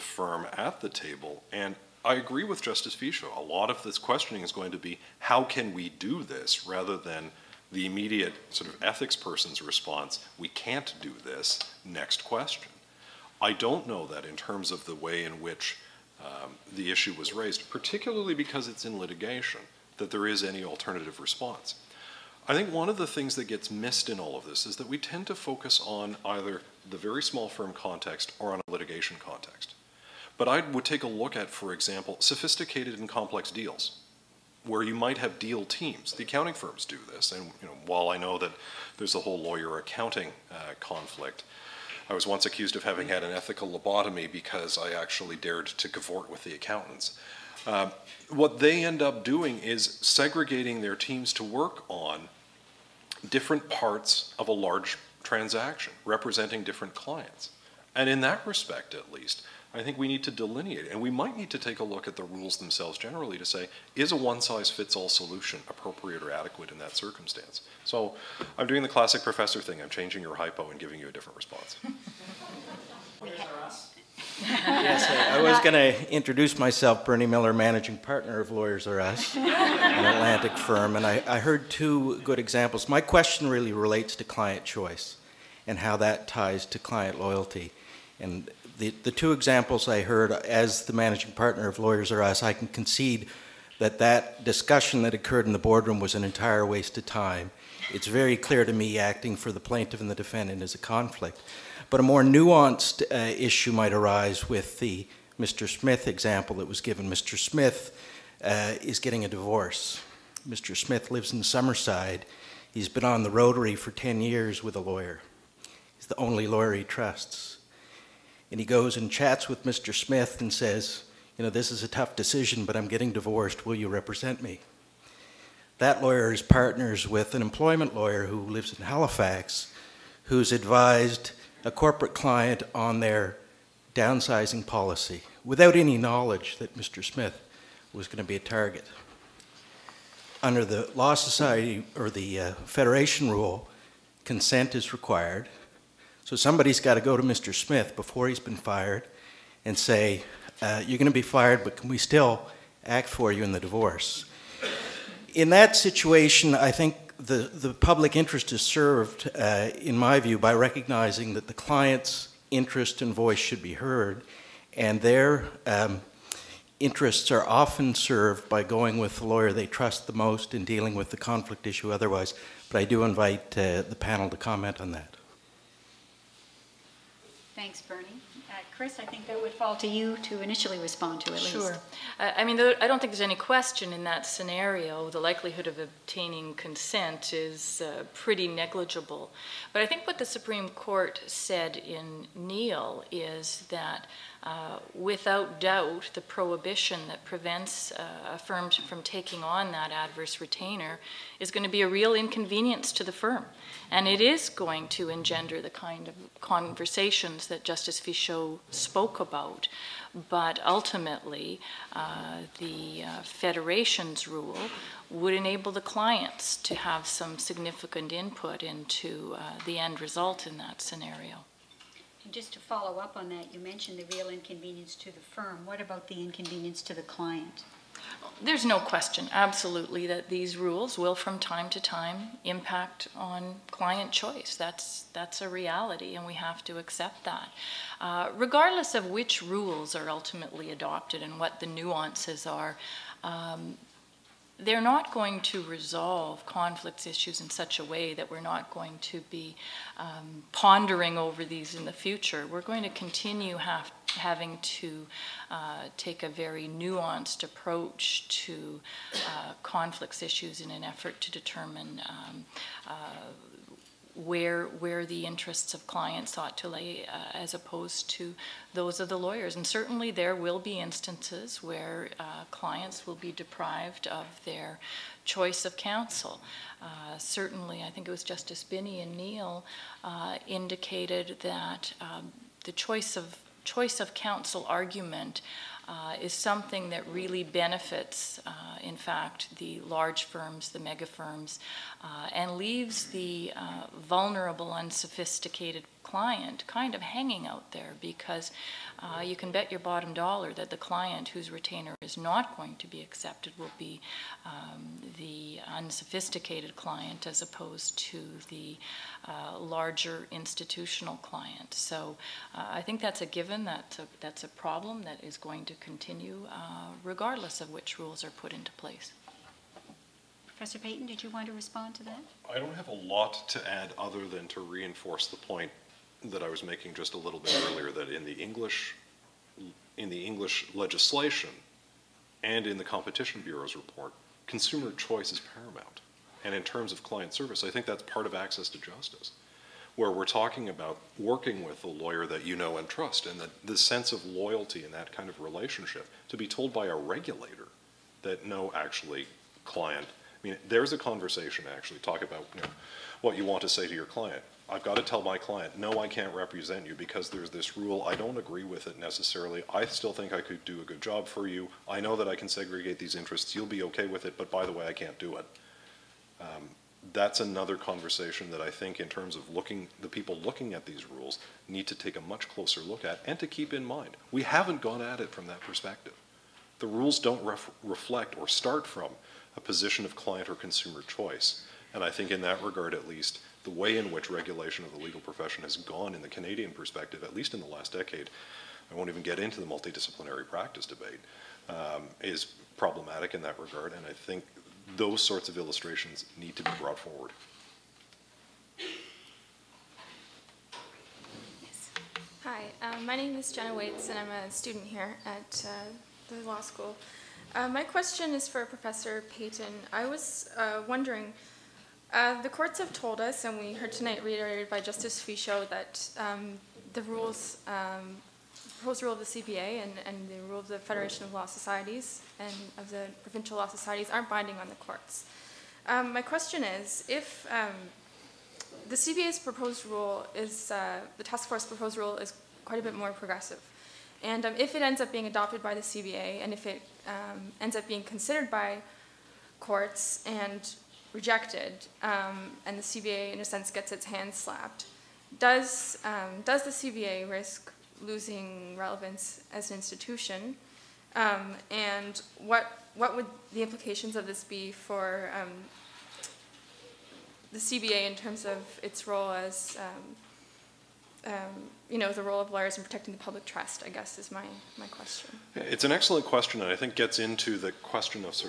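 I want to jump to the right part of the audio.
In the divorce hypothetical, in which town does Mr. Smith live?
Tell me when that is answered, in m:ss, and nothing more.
1:51.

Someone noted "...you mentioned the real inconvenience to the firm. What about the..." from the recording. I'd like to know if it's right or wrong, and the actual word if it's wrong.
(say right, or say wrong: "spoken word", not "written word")
right.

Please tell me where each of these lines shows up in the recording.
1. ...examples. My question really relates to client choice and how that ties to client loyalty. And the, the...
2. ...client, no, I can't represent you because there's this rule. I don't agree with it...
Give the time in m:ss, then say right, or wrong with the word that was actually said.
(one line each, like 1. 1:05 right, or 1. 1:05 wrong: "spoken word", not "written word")
1. 1:22 right
2. 5:55 right.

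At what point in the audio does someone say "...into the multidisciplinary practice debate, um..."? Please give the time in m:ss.
6:29.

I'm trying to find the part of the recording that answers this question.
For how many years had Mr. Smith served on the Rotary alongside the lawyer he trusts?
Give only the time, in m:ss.
1:53.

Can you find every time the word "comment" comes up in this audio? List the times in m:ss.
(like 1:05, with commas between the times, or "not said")
2:54.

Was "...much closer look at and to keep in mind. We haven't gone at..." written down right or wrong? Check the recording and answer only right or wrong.
right.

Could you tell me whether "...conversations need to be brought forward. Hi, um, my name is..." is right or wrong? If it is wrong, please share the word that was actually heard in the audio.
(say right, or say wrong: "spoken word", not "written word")
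wrong: "illustrations", not "conversations".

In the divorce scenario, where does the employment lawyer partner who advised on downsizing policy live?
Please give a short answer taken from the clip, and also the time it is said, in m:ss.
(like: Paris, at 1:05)
Halifax, at 2:08.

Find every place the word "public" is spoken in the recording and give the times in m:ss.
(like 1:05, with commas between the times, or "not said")
2:37, 7:43.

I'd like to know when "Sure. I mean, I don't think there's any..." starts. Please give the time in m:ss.
3:01.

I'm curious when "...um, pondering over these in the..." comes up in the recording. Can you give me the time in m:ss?
4:09.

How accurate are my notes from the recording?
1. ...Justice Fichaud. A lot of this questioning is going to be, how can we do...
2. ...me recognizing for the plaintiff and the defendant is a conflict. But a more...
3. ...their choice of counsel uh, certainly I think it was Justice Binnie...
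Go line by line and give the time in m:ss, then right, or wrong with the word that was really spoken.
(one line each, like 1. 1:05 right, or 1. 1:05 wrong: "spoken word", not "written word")
1. 0:02 right
2. 1:38 wrong: "acting", not "recognizing"
3. 4:34 right.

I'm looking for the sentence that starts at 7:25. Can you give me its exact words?
Does, um, does the CBA risk losing relevance as an institution?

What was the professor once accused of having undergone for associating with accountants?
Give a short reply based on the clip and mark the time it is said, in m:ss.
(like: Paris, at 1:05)
An ethical lobotomy, at 0:43.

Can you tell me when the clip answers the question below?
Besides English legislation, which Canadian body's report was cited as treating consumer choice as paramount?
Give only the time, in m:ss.
5:32.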